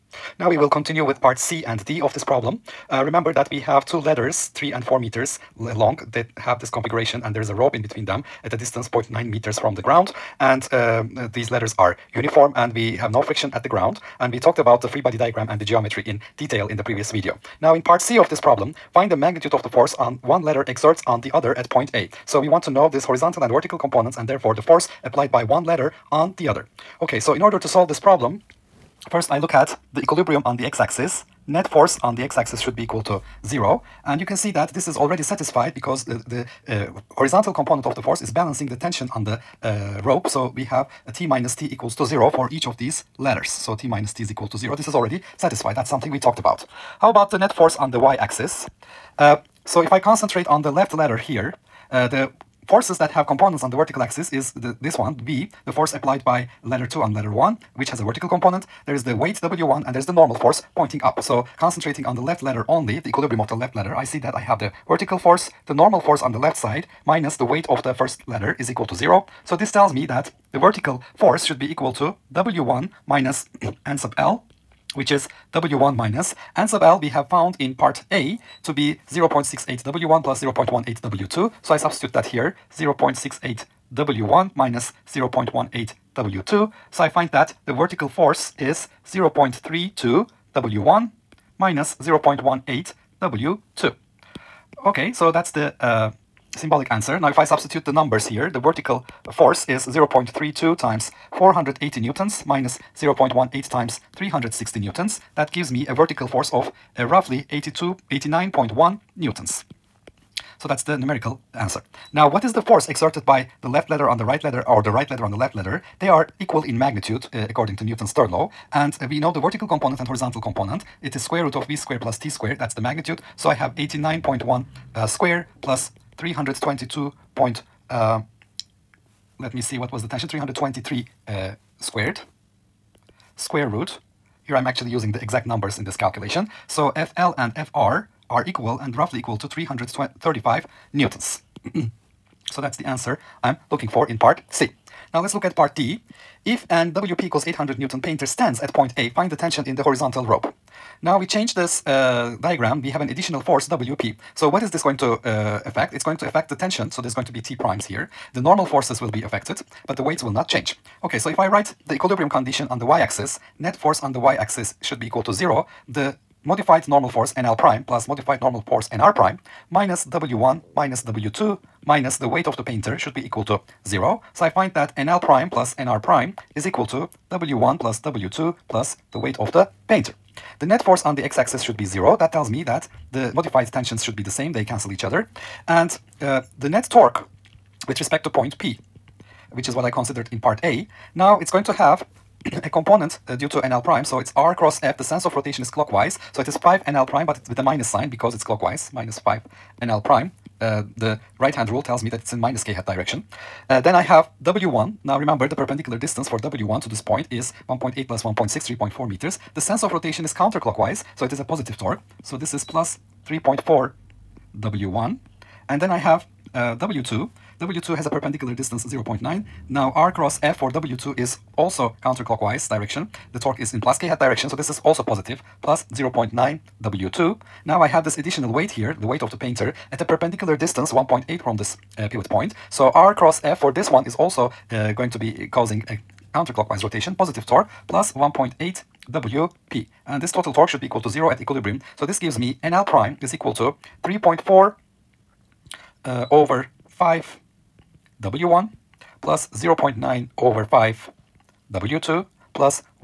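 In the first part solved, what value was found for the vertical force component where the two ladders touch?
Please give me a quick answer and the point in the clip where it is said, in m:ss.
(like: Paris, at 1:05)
89.1 newtons, at 1:48.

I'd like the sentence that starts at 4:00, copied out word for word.
And this total torque should be equal to zero at equilibrium.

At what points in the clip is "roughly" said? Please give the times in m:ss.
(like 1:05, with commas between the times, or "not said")
1:47, 2:18.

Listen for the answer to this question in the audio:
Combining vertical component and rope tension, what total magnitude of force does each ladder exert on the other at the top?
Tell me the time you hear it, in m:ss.
2:19.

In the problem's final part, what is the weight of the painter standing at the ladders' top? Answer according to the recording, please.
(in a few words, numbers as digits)
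800 newtons.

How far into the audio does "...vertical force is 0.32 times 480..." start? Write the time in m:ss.
1:38.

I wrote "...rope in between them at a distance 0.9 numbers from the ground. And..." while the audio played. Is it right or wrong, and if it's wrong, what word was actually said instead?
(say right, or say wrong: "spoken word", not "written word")
wrong: "meters", not "numbers".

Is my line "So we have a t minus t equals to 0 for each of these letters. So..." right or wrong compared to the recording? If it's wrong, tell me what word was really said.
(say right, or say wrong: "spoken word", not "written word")
right.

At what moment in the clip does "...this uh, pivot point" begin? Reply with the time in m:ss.
3:51.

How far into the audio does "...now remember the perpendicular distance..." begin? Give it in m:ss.
3:25.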